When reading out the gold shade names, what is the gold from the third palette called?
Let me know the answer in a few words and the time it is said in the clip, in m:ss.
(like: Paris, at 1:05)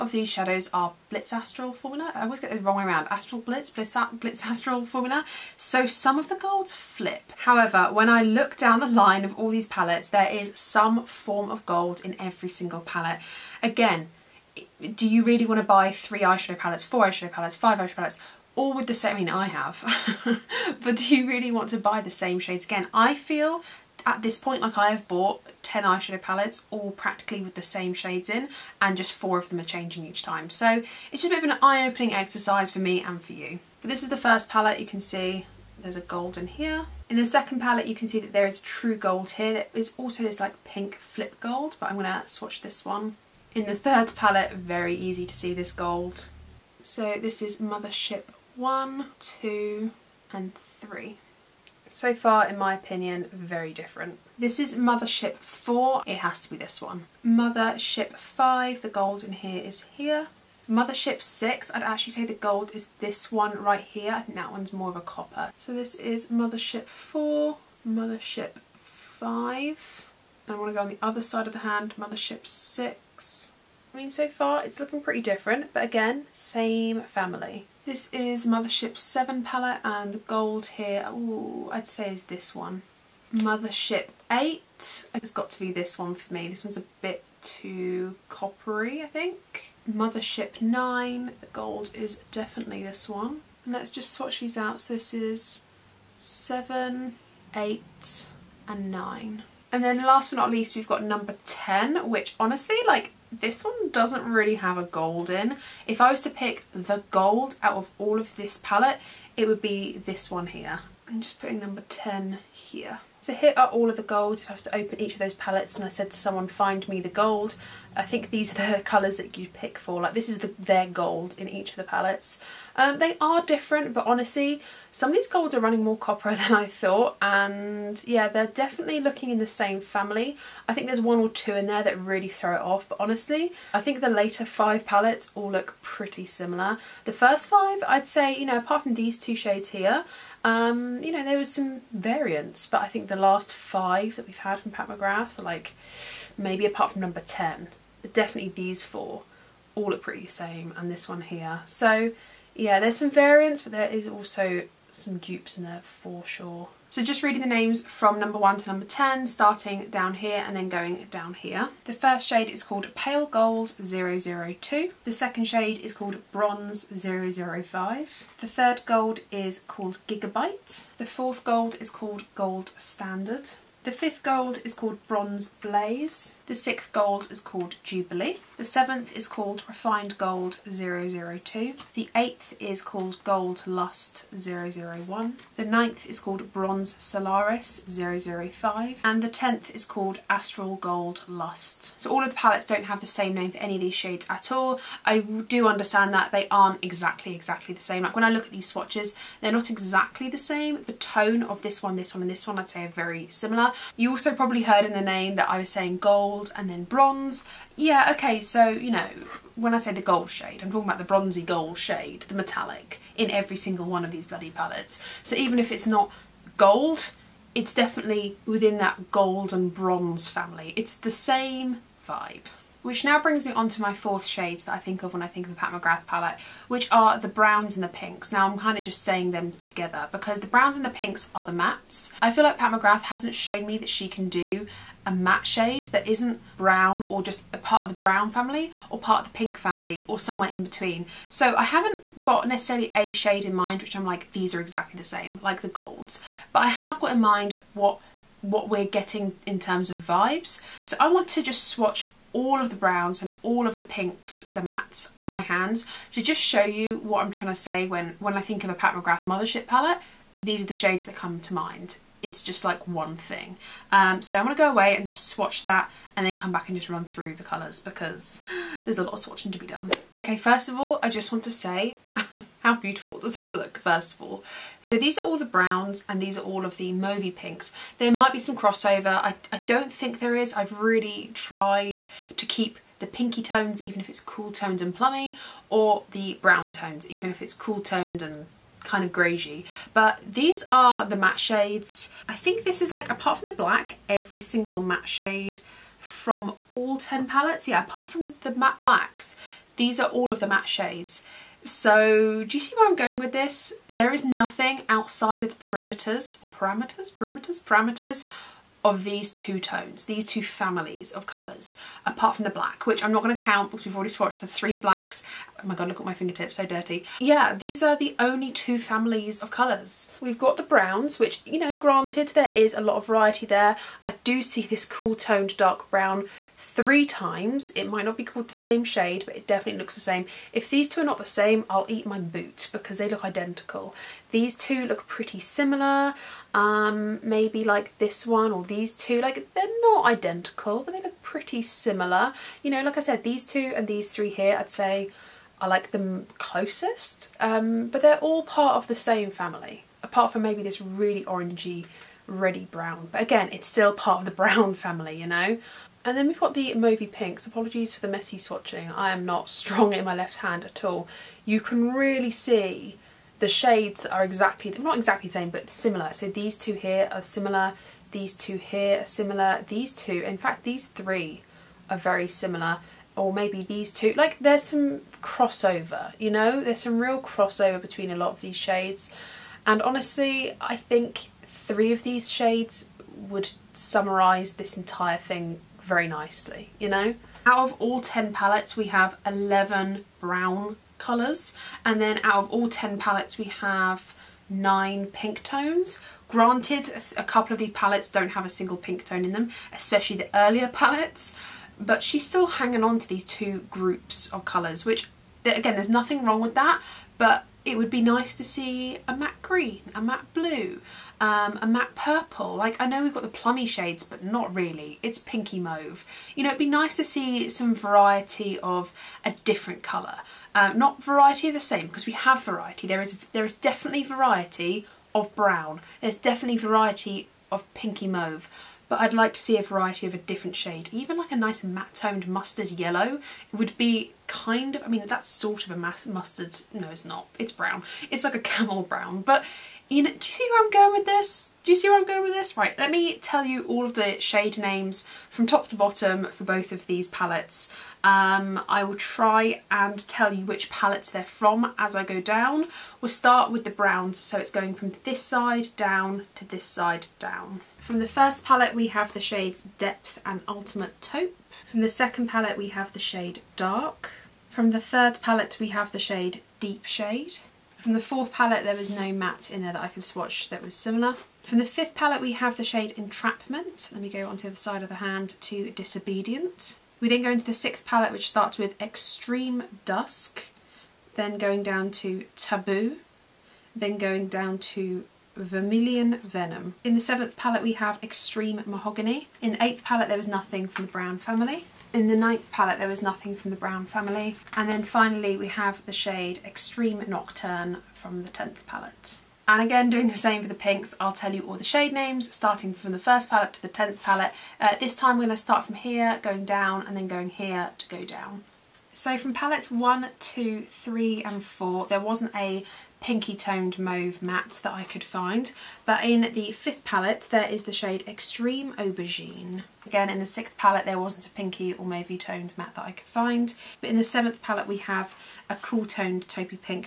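Gigabyte, at 2:50.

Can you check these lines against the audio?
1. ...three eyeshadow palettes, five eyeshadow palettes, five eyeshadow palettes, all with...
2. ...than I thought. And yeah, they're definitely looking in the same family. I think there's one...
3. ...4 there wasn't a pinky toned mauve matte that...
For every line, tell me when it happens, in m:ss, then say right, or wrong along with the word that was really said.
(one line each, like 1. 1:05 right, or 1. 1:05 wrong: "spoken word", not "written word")
1. 0:15 wrong: "four", not "five"
2. 2:06 right
3. 8:31 right.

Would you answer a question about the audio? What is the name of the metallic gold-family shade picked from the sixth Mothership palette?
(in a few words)
Jubilee.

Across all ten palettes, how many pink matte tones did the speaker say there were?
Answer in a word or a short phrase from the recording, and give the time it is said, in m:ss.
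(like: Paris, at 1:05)
9, at 6:34.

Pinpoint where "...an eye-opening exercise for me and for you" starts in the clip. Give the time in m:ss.
0:31.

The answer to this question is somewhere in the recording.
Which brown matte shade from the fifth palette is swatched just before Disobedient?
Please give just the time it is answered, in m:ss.
7:52.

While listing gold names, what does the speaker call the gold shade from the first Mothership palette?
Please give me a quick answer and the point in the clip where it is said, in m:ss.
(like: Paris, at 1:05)
Pale Gold 002, at 2:42.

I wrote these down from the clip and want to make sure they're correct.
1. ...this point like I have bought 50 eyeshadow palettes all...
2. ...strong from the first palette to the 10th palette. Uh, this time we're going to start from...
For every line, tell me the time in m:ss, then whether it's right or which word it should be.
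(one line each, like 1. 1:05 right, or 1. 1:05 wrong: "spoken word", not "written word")
1. 0:24 wrong: "10", not "50"
2. 8:22 wrong: "starting", not "strong".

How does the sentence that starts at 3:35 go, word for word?
So even if it's not gold, it's definitely within that gold and bronze family.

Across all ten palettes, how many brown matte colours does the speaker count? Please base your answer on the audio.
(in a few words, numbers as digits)
11.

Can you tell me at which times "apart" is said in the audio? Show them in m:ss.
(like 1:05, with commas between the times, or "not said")
2:18, 2:26, 4:53, 4:57, 5:12, 5:50.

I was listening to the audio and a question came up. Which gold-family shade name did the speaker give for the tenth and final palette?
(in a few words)
Astral Gold Lust.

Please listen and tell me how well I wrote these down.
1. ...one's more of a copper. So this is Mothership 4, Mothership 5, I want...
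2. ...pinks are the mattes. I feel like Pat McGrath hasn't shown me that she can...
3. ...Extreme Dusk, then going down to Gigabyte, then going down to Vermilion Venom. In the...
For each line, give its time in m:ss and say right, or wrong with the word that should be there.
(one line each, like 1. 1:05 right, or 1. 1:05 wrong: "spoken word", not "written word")
1. 1:04 right
2. 3:50 right
3. 7:58 wrong: "Taboo", not "Gigabyte".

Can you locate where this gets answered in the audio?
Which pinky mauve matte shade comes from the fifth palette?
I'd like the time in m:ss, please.
8:38.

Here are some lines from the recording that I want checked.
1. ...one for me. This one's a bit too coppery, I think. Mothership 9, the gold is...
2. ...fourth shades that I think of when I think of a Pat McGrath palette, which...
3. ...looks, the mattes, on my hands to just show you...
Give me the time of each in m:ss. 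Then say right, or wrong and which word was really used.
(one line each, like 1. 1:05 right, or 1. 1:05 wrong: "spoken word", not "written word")
1. 1:25 right
2. 3:43 right
3. 4:13 wrong: "pinks", not "looks".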